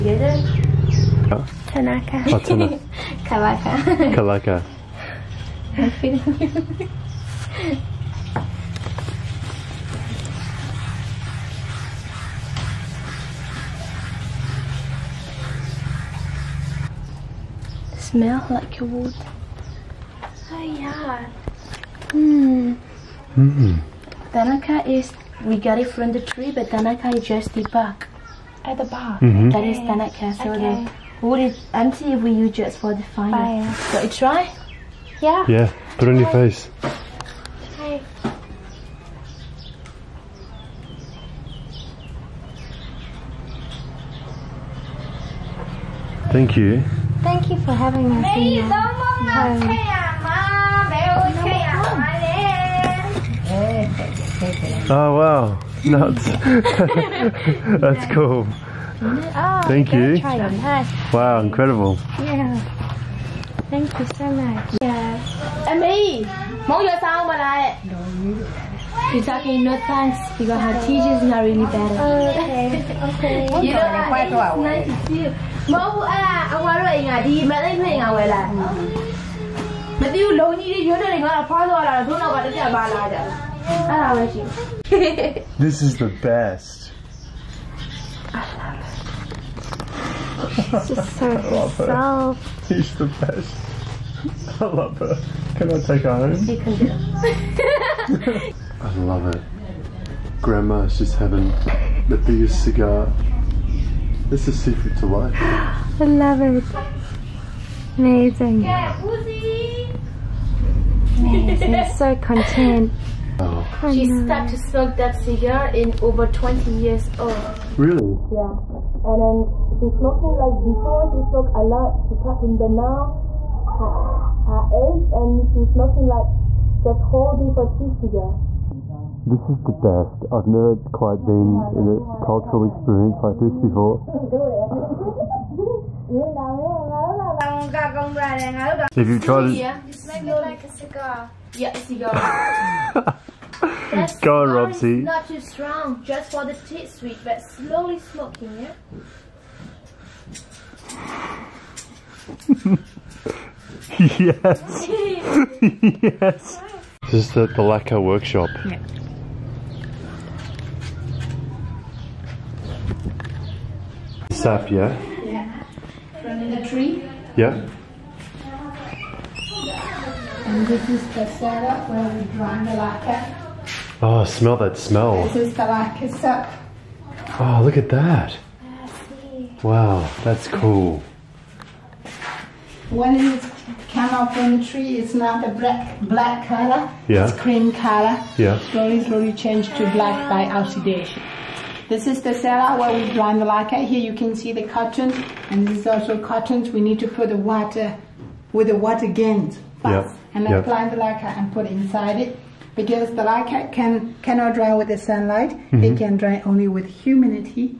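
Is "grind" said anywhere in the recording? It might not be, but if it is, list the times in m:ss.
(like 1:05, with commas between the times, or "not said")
2:52, 3:13.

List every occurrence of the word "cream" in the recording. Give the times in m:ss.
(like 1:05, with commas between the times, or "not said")
3:07.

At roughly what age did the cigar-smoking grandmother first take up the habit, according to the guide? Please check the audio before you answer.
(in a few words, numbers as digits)
Over 20.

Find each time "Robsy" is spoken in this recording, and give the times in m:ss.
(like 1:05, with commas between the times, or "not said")
2:24.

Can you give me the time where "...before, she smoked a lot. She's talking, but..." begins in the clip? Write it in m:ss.
2:00.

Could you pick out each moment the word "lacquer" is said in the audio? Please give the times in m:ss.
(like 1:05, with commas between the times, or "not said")
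2:37, 2:52, 3:13, 3:20.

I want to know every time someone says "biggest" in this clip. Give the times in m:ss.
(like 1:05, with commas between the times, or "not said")
1:42.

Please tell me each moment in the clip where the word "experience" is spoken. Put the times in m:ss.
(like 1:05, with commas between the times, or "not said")
2:12.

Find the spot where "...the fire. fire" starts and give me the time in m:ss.
0:32.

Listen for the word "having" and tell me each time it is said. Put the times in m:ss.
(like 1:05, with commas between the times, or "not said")
0:47, 1:41.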